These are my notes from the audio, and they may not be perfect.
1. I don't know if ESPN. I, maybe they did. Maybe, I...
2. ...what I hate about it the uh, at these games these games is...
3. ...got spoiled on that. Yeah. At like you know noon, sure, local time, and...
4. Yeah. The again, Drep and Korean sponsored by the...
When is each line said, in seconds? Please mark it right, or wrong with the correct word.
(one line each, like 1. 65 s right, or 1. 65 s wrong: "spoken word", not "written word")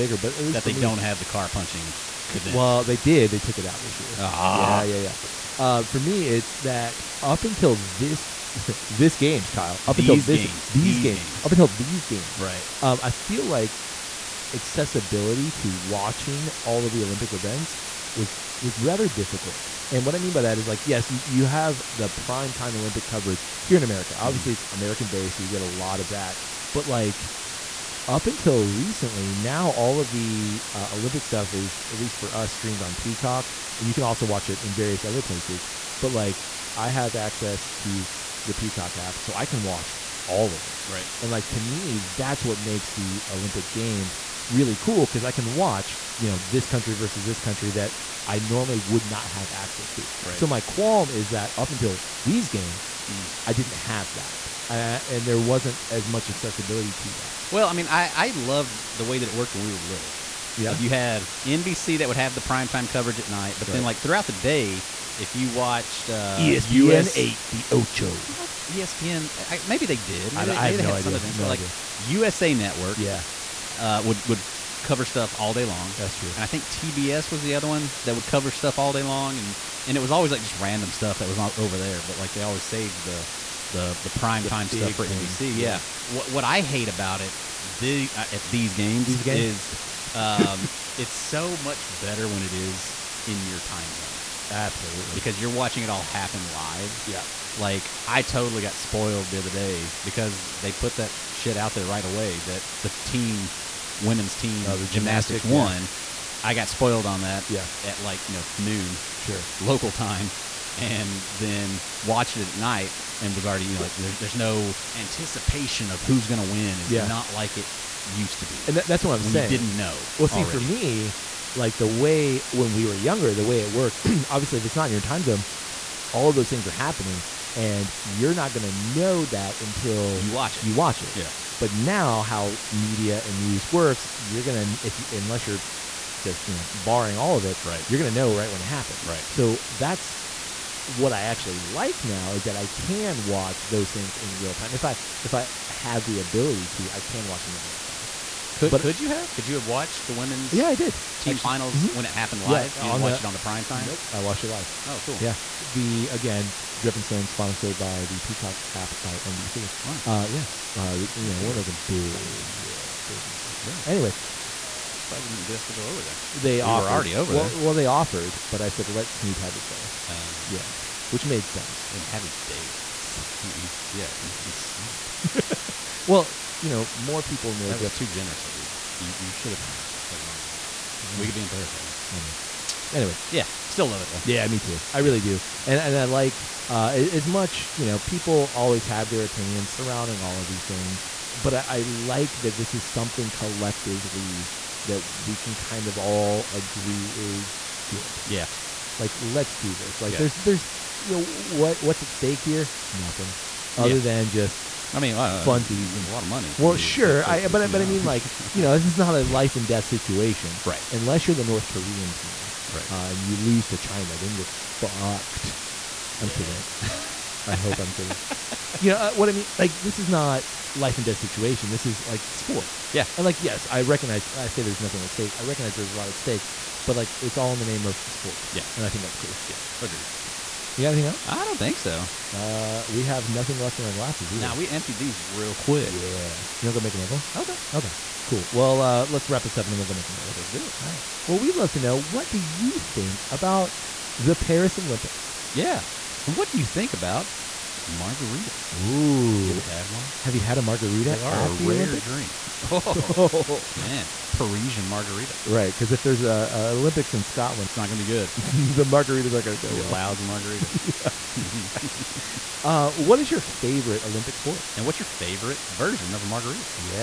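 1. 68 s right
2. 86 s right
3. 106 s right
4. 155 s wrong: "Stone", not "Korean".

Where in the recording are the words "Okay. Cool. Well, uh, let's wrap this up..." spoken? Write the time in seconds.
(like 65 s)
237 s.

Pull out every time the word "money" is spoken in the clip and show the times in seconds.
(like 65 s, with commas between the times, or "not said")
163 s, 206 s.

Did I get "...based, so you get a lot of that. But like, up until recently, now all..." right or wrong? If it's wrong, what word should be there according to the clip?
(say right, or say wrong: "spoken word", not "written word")
right.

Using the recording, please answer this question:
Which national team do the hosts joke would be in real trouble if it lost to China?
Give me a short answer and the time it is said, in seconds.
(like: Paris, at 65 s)
North Korean team, at 211 s.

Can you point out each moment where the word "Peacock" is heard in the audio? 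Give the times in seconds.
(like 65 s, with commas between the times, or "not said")
32 s, 38 s, 158 s.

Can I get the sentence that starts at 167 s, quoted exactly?
Well, they offered, but I said let Snoop have his day.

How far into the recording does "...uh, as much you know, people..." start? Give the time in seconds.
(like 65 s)
186 s.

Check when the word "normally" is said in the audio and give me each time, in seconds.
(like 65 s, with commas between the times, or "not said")
48 s.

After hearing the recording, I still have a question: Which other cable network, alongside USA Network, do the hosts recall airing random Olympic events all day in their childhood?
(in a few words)
TBS.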